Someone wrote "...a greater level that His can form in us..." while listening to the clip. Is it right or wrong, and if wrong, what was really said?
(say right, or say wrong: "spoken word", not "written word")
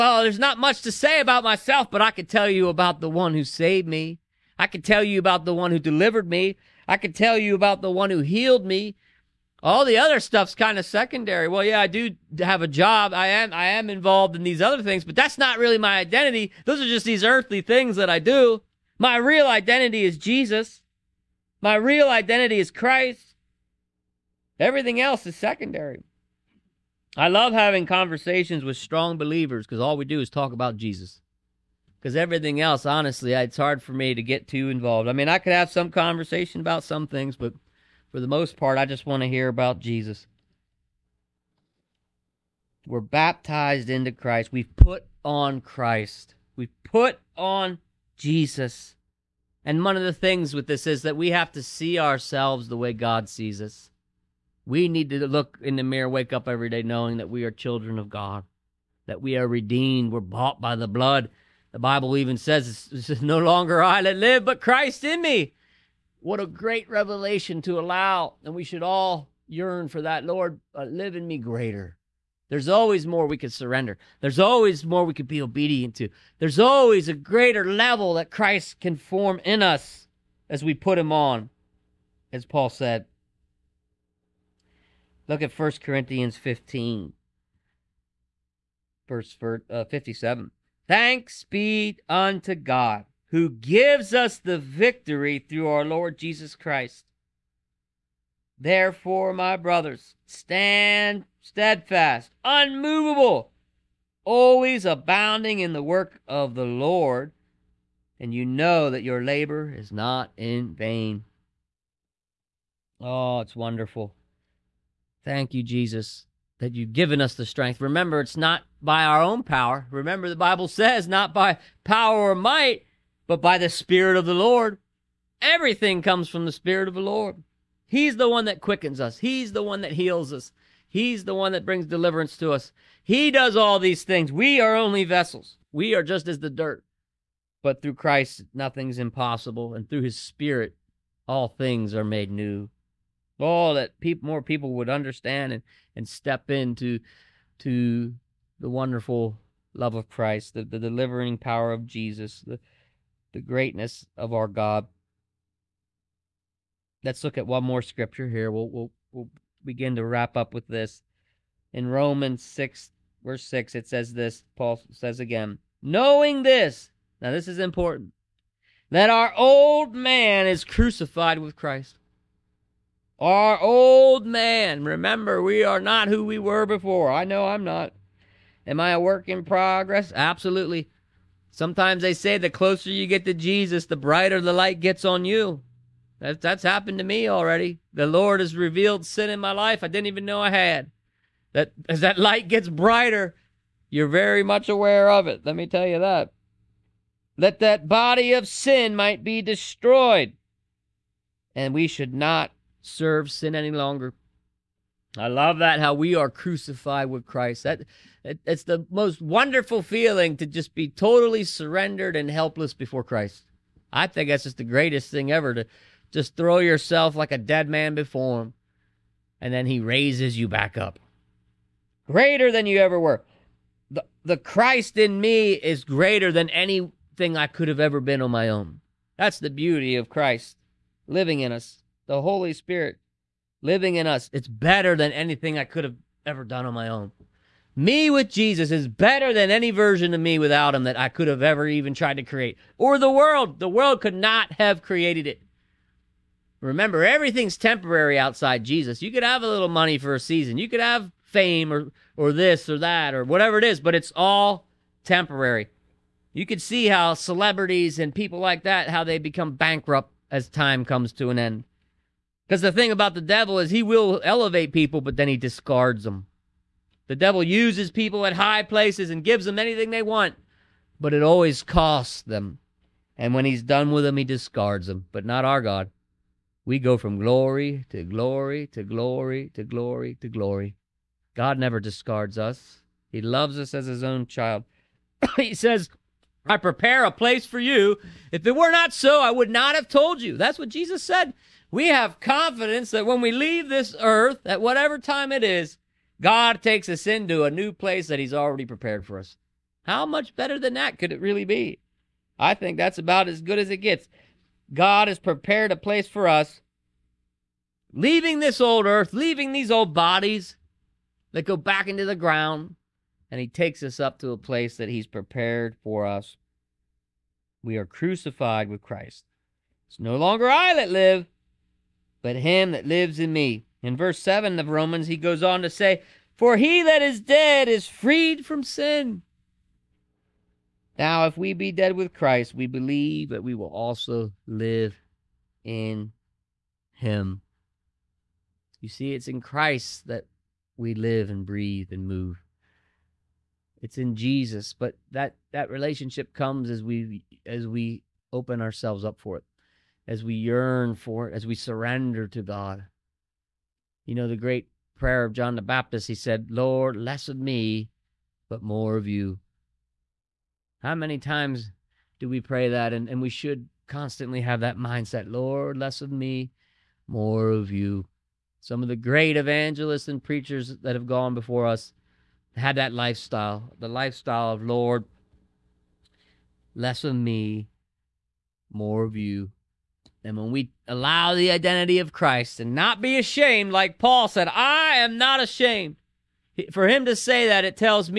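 wrong: "Christ", not "His".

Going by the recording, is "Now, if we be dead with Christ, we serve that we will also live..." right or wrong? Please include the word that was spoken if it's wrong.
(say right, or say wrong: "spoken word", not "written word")
wrong: "believe", not "serve".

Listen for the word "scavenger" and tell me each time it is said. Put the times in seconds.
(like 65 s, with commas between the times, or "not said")
not said.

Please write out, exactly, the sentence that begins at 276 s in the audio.
We go from glory to glory to glory to glory to glory.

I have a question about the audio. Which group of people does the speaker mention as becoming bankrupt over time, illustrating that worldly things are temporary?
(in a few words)
Celebrities.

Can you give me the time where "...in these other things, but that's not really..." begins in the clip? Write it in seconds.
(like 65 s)
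14 s.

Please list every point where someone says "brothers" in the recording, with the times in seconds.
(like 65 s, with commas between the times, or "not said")
99 s.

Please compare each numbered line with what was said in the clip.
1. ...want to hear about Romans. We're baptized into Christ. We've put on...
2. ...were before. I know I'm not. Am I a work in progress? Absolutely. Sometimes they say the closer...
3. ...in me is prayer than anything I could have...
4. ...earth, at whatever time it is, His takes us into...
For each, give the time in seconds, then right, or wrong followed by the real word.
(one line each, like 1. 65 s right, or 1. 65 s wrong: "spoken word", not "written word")
1. 39 s wrong: "Jesus", not "Romans"
2. 176 s right
3. 224 s wrong: "greater", not "prayer"
4. 293 s wrong: "God", not "His".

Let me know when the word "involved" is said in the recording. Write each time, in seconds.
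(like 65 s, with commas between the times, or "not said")
13 s, 34 s.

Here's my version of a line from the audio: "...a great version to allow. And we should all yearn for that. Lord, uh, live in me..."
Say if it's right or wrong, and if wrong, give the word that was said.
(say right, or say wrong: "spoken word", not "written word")
wrong: "revelation", not "version".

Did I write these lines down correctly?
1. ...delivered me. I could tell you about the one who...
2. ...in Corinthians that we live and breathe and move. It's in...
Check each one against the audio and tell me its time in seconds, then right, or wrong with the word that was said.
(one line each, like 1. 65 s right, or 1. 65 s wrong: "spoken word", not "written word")
1. 5 s right
2. 339 s wrong: "Christ", not "Corinthians".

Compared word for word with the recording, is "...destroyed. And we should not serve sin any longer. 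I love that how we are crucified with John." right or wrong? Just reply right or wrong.
wrong.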